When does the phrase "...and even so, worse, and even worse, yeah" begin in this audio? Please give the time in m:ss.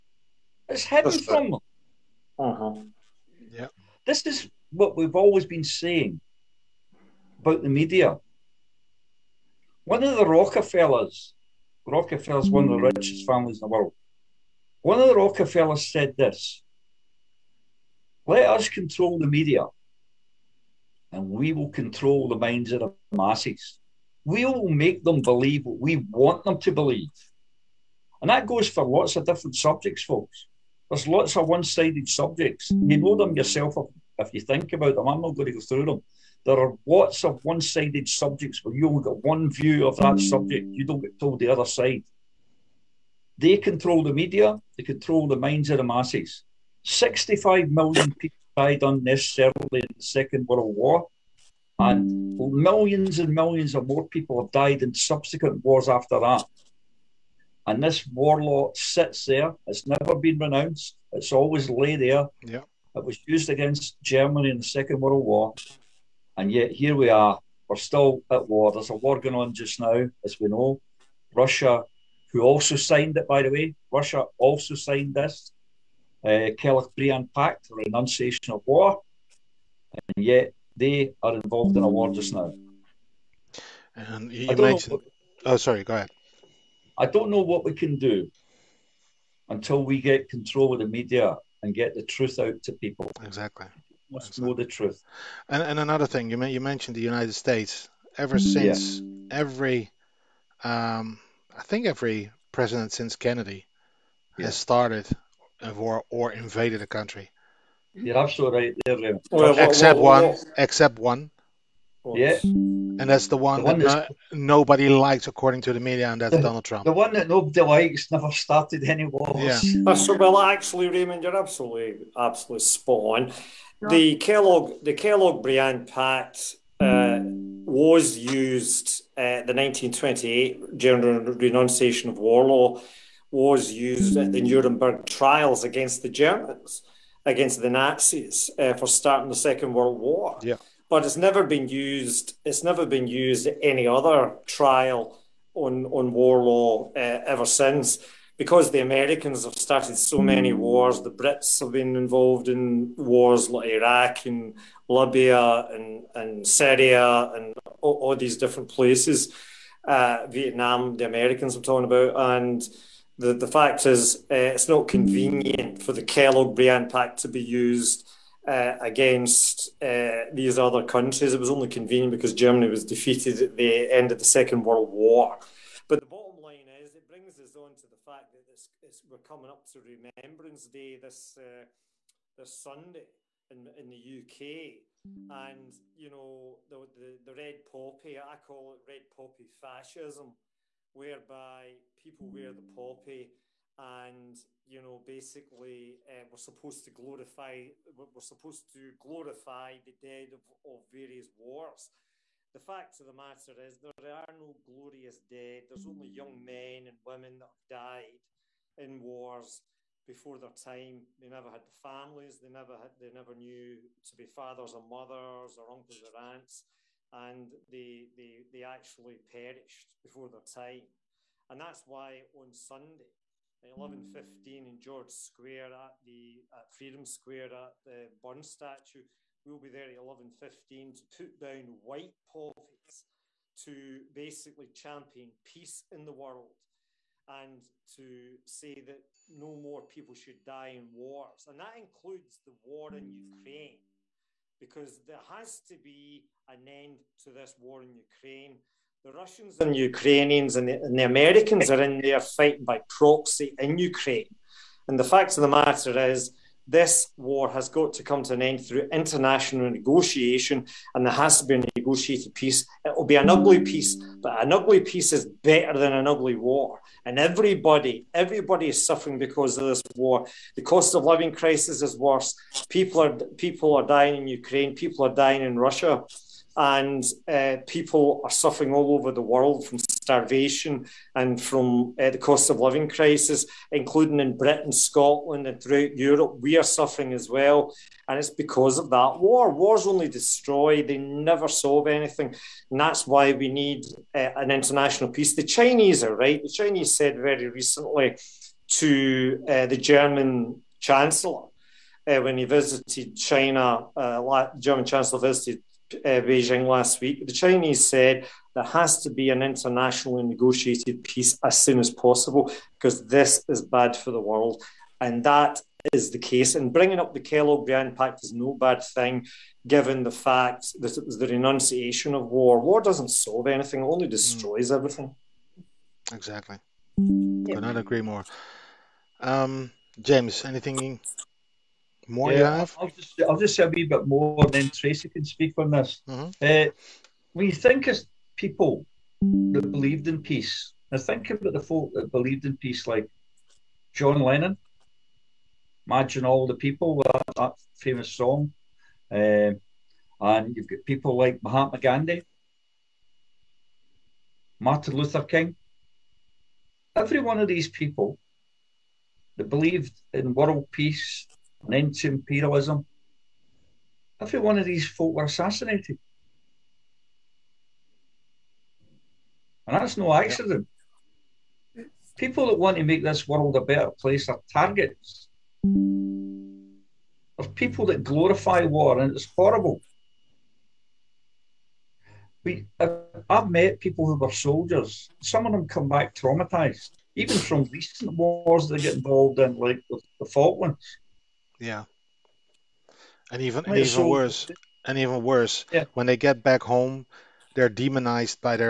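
6:33.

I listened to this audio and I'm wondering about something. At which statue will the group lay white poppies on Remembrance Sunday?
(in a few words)
Burn statue.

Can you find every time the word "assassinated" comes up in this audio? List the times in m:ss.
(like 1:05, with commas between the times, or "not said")
6:05.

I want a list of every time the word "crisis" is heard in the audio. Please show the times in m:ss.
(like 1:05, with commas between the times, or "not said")
4:31, 4:42.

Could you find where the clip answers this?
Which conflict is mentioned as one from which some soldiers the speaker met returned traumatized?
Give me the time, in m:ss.
6:30.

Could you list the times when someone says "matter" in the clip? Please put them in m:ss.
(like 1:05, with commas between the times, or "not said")
3:23, 4:15.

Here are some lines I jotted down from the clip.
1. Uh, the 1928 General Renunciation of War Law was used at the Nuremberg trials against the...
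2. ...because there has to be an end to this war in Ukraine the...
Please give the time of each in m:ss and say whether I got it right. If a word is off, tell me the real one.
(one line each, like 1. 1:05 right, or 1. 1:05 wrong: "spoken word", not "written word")
1. 2:09 right
2. 4:04 right.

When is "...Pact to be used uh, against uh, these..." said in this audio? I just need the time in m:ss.
2:46.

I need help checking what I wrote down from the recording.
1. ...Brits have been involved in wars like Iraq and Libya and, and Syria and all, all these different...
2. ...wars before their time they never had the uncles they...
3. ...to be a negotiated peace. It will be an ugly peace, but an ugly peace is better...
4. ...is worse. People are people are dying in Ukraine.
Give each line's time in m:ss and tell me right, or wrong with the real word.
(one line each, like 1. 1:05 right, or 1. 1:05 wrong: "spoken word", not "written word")
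1. 2:31 right
2. 3:28 wrong: "families", not "uncles"
3. 4:21 right
4. 4:31 right.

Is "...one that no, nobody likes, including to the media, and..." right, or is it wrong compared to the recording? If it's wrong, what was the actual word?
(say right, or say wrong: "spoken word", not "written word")
wrong: "according", not "including".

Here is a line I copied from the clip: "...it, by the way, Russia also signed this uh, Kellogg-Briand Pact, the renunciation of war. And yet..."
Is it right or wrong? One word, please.
right.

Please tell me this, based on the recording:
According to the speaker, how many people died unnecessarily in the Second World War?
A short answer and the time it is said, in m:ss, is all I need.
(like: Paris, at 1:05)
65 million, at 0:46.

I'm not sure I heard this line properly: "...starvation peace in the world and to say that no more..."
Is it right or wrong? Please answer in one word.
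wrong.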